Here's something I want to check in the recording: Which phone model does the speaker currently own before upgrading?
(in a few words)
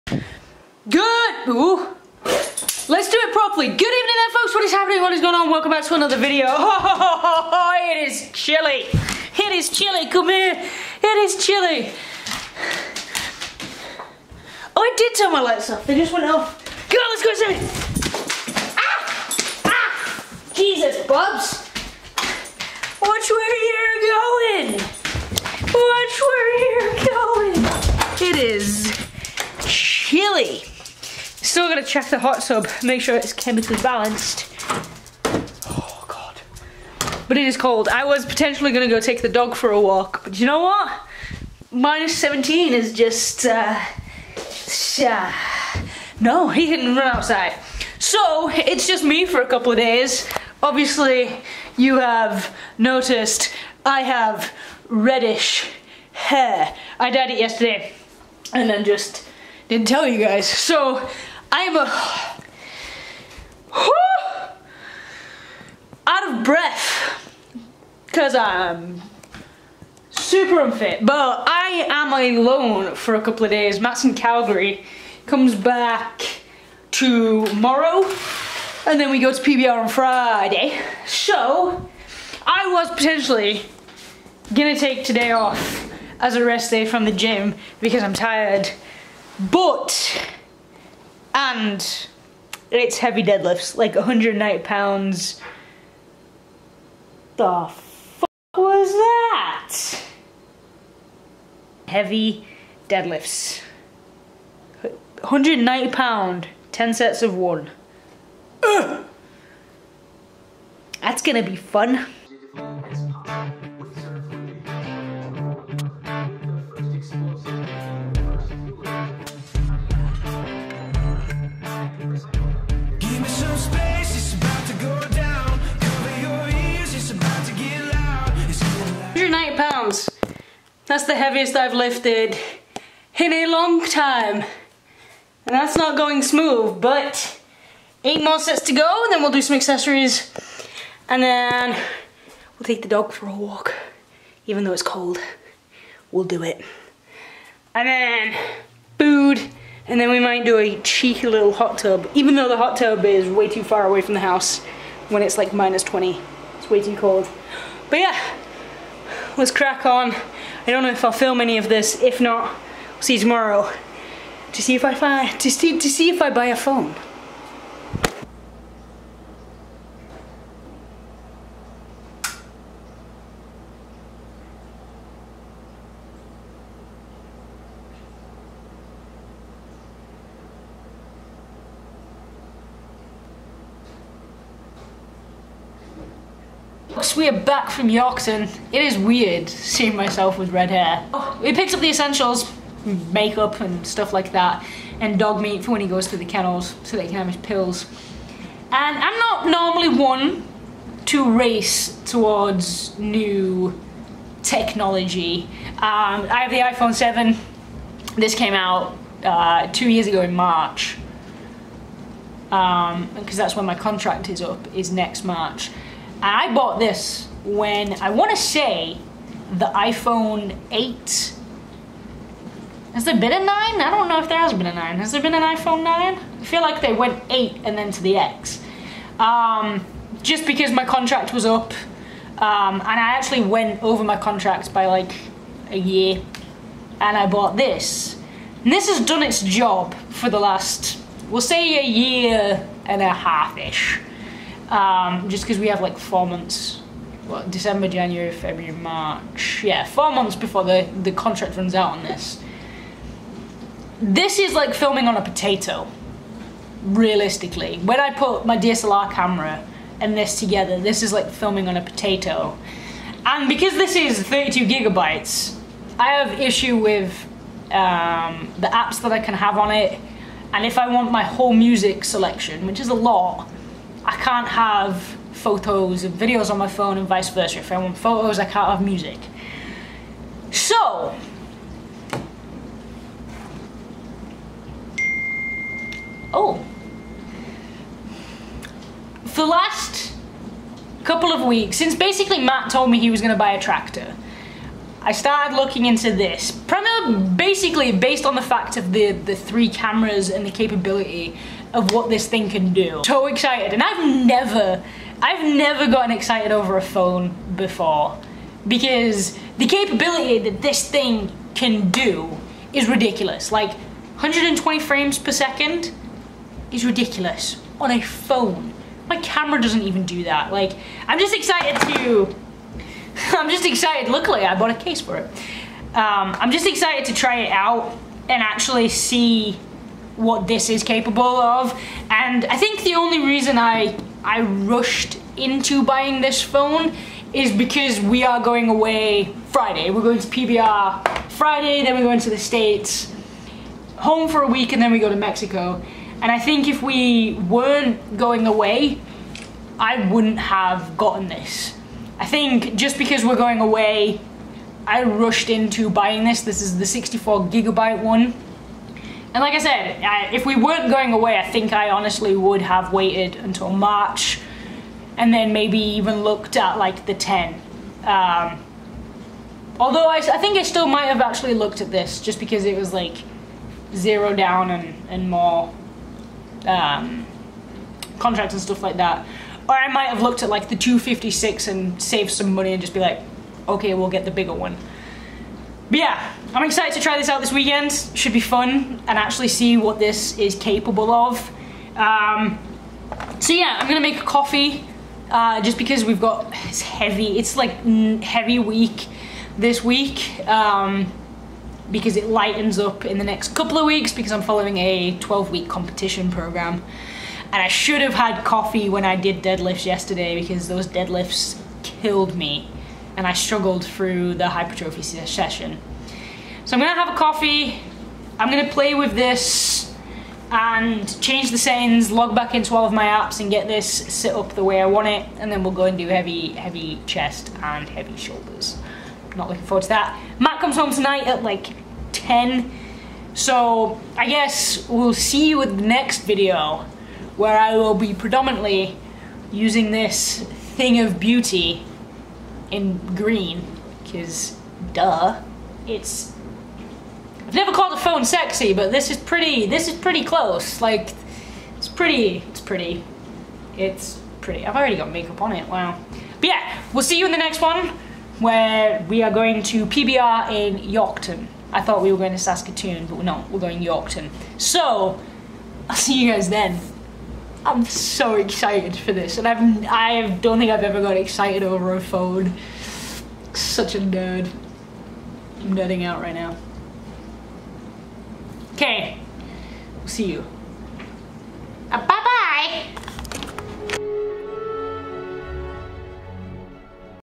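iPhone 7.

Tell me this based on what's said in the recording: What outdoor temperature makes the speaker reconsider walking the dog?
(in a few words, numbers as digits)
-17.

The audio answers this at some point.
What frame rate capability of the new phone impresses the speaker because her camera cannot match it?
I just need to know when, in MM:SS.
05:13.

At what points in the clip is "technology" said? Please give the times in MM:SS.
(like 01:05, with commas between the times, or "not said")
03:24.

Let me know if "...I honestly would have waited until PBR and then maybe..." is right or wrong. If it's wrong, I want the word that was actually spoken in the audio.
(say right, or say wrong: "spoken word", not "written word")
wrong: "March", not "PBR".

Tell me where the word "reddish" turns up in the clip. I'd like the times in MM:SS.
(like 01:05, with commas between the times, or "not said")
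00:54.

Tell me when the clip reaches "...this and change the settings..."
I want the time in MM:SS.
06:59.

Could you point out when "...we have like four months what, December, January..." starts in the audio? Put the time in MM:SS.
04:05.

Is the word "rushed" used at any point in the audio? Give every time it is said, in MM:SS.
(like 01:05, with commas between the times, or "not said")
05:34, 05:55.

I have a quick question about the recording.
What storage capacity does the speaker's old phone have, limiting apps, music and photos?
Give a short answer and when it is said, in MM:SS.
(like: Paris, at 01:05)
32 gigabytes, at 04:24.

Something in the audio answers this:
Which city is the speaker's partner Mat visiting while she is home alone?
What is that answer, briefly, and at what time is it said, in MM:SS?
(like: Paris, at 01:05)
Calgary, at 01:14.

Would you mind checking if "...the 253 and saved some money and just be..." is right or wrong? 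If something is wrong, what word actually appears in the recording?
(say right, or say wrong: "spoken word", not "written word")
wrong: "256", not "253".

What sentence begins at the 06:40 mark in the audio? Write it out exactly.
Um, because it lightens up in the next couple of weeks because I'm following a 12 week competition program.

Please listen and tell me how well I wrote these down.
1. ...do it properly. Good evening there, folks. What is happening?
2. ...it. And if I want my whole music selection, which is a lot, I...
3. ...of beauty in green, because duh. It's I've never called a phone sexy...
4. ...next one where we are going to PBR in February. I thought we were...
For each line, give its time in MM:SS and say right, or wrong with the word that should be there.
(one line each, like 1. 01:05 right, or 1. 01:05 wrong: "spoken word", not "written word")
1. 00:03 right
2. 04:29 right
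3. 07:20 right
4. 07:37 wrong: "Yorkton", not "February".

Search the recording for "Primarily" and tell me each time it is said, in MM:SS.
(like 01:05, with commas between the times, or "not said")
04:56.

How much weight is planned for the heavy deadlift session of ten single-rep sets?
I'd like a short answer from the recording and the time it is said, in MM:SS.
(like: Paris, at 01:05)
190 pounds, at 01:33.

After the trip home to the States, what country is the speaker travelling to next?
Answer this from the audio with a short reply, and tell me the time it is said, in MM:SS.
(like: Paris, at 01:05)
Mexico, at 05:45.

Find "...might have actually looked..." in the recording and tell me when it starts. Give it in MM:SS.
06:10.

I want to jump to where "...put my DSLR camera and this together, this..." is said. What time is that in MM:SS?
04:18.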